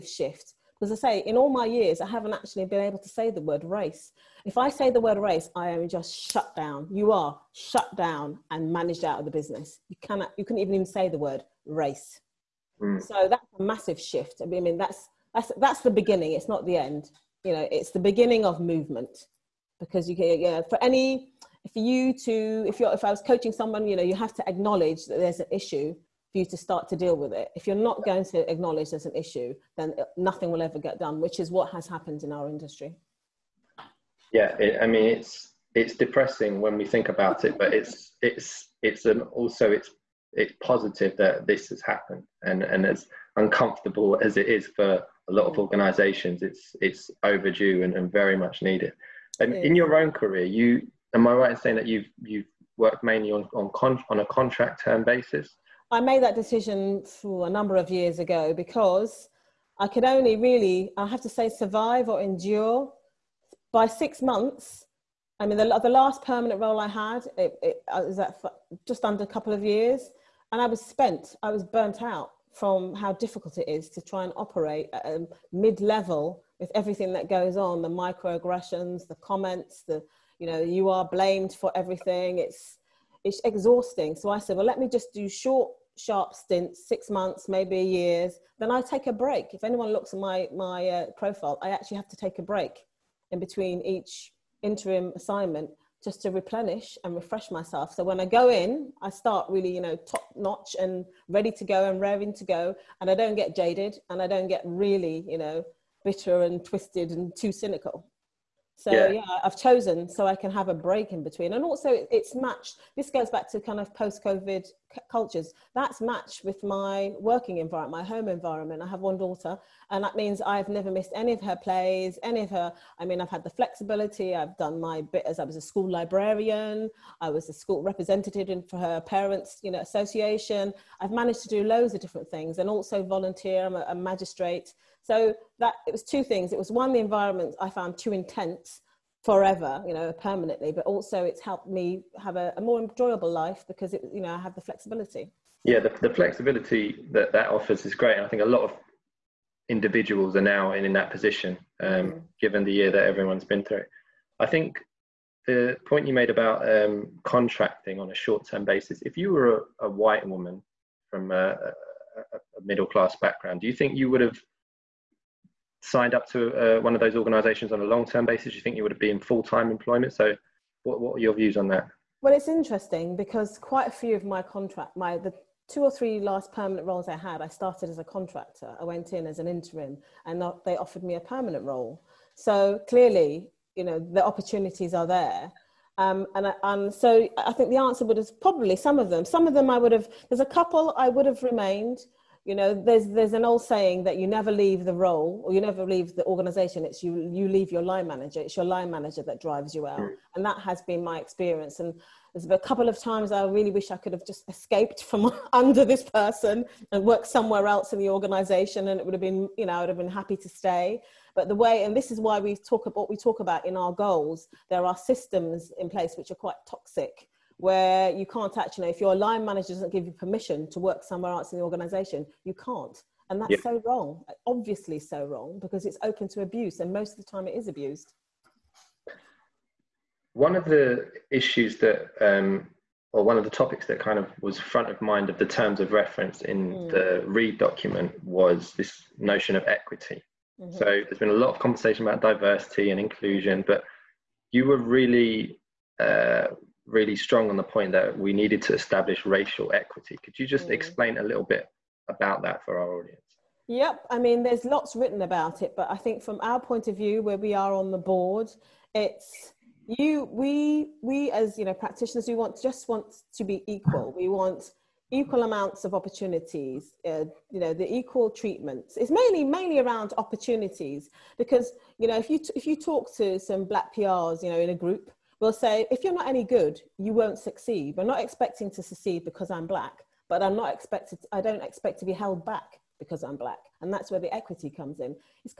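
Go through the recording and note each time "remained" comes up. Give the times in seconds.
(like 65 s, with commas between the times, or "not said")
191 s.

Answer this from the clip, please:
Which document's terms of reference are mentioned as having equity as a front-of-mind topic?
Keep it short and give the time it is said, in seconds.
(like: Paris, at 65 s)
REEB document, at 237 s.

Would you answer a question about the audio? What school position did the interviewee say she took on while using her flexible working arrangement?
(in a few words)
School librarian.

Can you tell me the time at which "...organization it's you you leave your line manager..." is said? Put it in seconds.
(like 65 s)
196 s.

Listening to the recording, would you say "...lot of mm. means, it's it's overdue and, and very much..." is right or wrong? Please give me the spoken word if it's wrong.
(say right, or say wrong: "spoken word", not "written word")
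wrong: "organisations", not "means".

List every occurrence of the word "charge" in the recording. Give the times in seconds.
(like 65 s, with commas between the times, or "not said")
not said.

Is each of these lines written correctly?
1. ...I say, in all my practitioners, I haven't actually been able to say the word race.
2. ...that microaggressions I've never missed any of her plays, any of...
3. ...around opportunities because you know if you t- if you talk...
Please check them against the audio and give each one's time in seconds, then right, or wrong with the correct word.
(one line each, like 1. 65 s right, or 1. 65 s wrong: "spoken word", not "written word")
1. 0 s wrong: "years", not "practitioners"
2. 120 s wrong: "means", not "microaggressions"
3. 269 s right.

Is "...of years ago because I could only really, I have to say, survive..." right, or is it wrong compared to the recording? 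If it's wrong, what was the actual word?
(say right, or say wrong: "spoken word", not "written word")
right.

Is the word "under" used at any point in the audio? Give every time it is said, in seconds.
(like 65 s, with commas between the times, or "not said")
69 s, 205 s.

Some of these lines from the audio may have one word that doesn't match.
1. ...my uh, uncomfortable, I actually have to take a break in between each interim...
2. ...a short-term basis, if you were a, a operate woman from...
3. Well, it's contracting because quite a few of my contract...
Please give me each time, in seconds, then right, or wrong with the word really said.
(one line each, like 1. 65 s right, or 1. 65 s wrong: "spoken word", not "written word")
1. 90 s wrong: "profile", not "uncomfortable"
2. 158 s wrong: "white", not "operate"
3. 172 s wrong: "interesting", not "contracting".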